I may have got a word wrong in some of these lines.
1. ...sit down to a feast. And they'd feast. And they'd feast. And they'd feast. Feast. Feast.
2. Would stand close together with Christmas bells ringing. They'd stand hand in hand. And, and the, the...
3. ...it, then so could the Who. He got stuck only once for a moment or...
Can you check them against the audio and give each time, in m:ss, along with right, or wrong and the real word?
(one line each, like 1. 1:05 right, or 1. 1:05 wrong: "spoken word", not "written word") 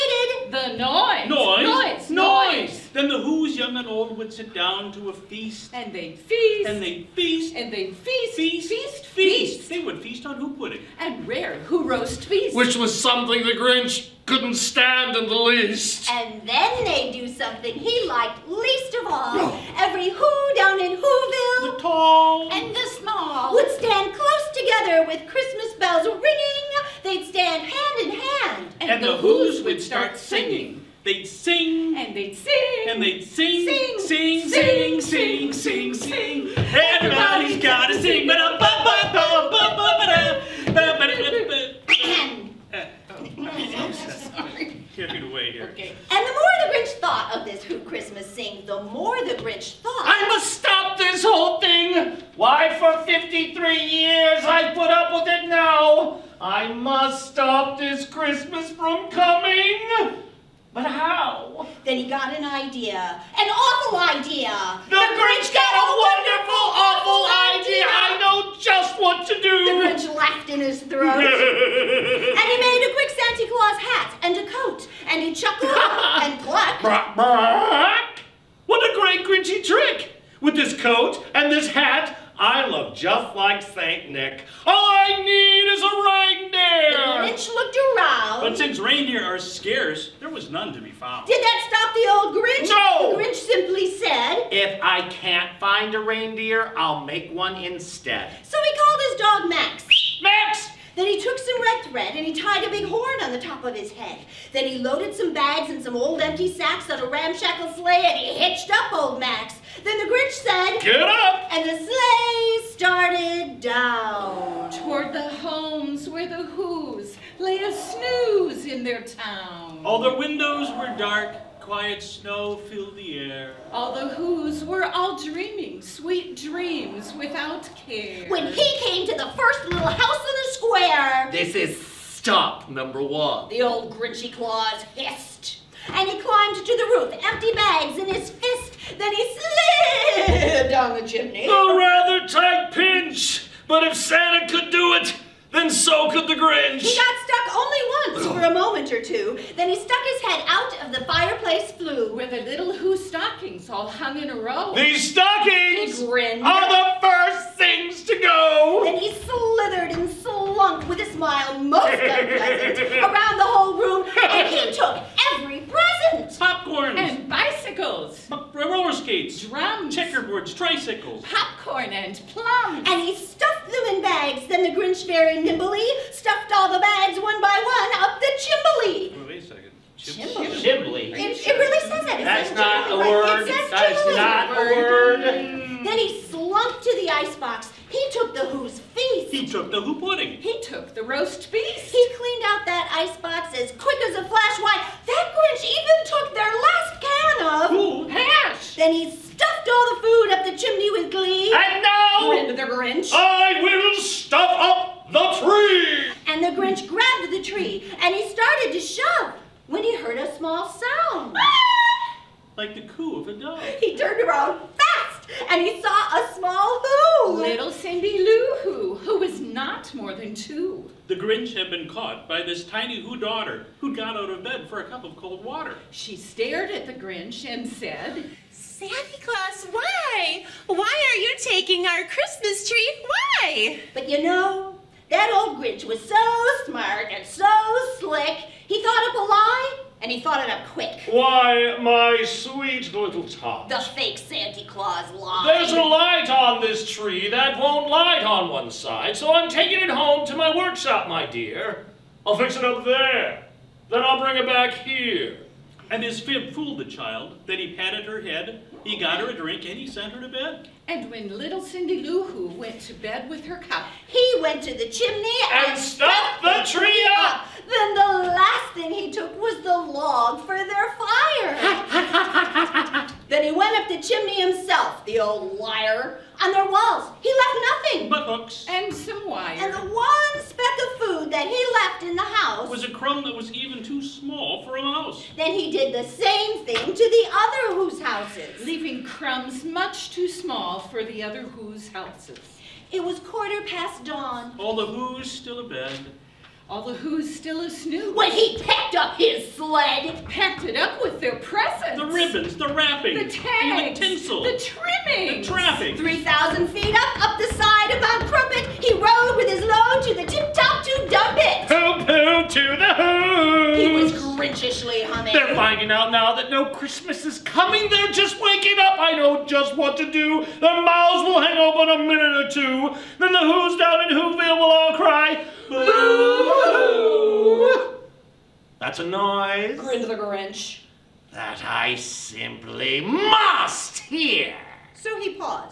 1. 0:04 right
2. 0:23 right
3. 2:24 wrong: "Grinch", not "Who".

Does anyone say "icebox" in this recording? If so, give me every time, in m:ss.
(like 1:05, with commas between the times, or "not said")
3:07, 3:12.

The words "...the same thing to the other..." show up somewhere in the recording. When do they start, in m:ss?
4:45.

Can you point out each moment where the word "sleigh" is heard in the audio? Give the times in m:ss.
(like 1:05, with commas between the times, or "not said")
1:47, 1:51.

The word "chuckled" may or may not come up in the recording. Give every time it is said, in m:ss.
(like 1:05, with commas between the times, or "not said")
1:15.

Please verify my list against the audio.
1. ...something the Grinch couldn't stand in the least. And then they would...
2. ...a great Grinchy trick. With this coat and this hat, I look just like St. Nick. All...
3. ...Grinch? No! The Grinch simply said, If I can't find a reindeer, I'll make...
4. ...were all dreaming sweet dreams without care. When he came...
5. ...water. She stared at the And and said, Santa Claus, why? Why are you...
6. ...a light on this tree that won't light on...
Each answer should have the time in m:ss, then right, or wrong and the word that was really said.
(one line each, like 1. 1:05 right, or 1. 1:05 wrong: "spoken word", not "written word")
1. 0:12 right
2. 1:18 right
3. 1:32 right
4. 2:04 right
5. 3:45 wrong: "Grinch", not "And"
6. 4:05 right.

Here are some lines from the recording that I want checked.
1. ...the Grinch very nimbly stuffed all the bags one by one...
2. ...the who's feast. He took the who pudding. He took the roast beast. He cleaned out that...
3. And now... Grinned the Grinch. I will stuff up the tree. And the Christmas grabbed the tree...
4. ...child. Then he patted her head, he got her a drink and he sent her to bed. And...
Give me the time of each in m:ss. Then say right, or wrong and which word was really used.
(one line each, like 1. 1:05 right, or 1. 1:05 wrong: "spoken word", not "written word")
1. 2:54 right
2. 3:08 right
3. 3:21 wrong: "Grinch", not "Christmas"
4. 4:16 right.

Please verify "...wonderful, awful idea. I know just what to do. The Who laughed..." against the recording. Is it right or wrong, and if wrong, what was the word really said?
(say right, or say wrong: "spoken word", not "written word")
wrong: "Grinch", not "Who".